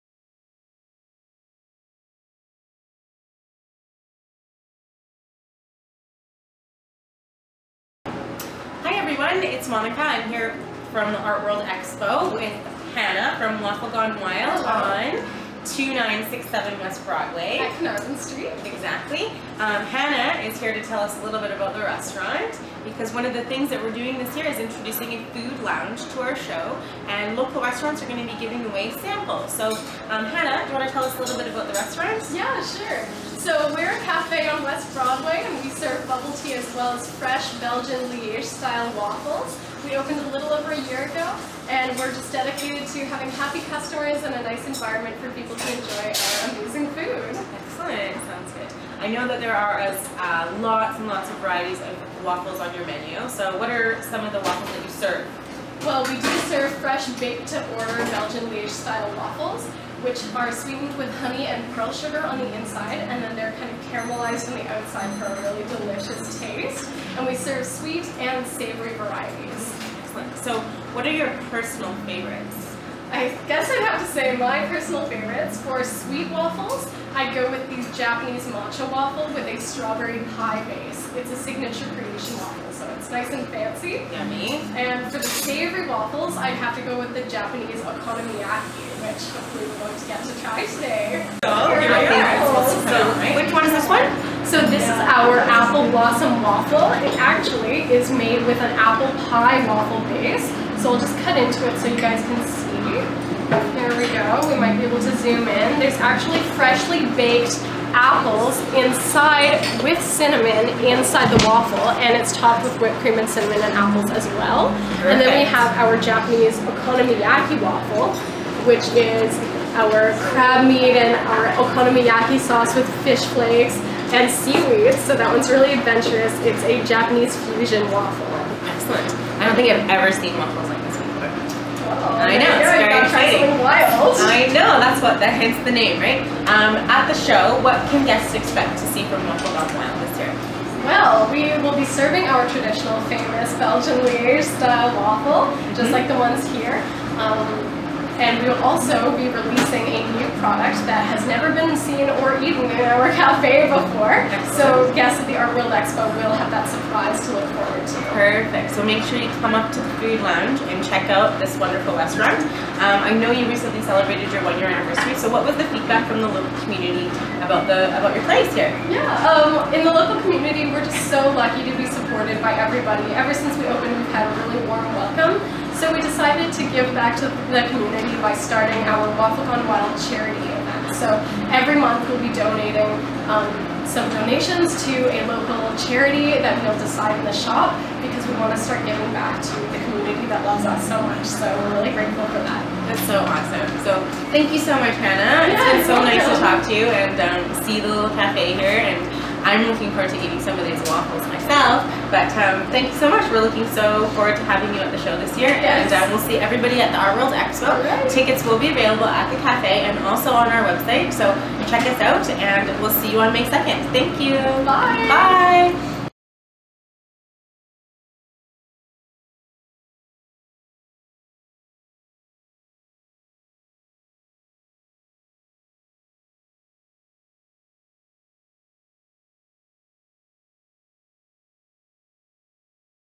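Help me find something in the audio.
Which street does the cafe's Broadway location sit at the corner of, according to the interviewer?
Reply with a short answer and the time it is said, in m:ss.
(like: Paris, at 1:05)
Carnarvon Street, at 0:17.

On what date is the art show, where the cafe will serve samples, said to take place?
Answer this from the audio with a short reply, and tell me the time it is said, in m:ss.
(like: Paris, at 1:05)
May 2nd, at 3:33.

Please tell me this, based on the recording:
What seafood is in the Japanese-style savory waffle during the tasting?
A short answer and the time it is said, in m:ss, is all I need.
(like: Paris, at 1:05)
crab meat, at 2:00.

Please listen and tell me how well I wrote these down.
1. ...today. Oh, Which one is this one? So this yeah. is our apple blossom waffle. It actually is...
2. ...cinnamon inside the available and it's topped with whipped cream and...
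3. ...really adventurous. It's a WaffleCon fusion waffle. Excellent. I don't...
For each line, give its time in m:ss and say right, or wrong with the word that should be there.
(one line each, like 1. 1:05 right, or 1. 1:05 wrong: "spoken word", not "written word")
1. 1:30 right
2. 1:50 wrong: "waffle", not "available"
3. 2:05 wrong: "Japanese", not "WaffleCon".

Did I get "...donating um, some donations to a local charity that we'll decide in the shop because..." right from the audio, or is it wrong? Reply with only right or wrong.
right.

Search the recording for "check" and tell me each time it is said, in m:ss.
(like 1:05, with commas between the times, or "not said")
2:40, 3:31.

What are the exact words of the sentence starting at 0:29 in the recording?
So um, Hannah, do you want to tell us a little bit about the restaurant?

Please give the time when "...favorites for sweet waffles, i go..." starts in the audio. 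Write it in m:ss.
1:15.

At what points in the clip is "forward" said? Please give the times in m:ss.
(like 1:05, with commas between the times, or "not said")
2:37, 3:19, 3:24.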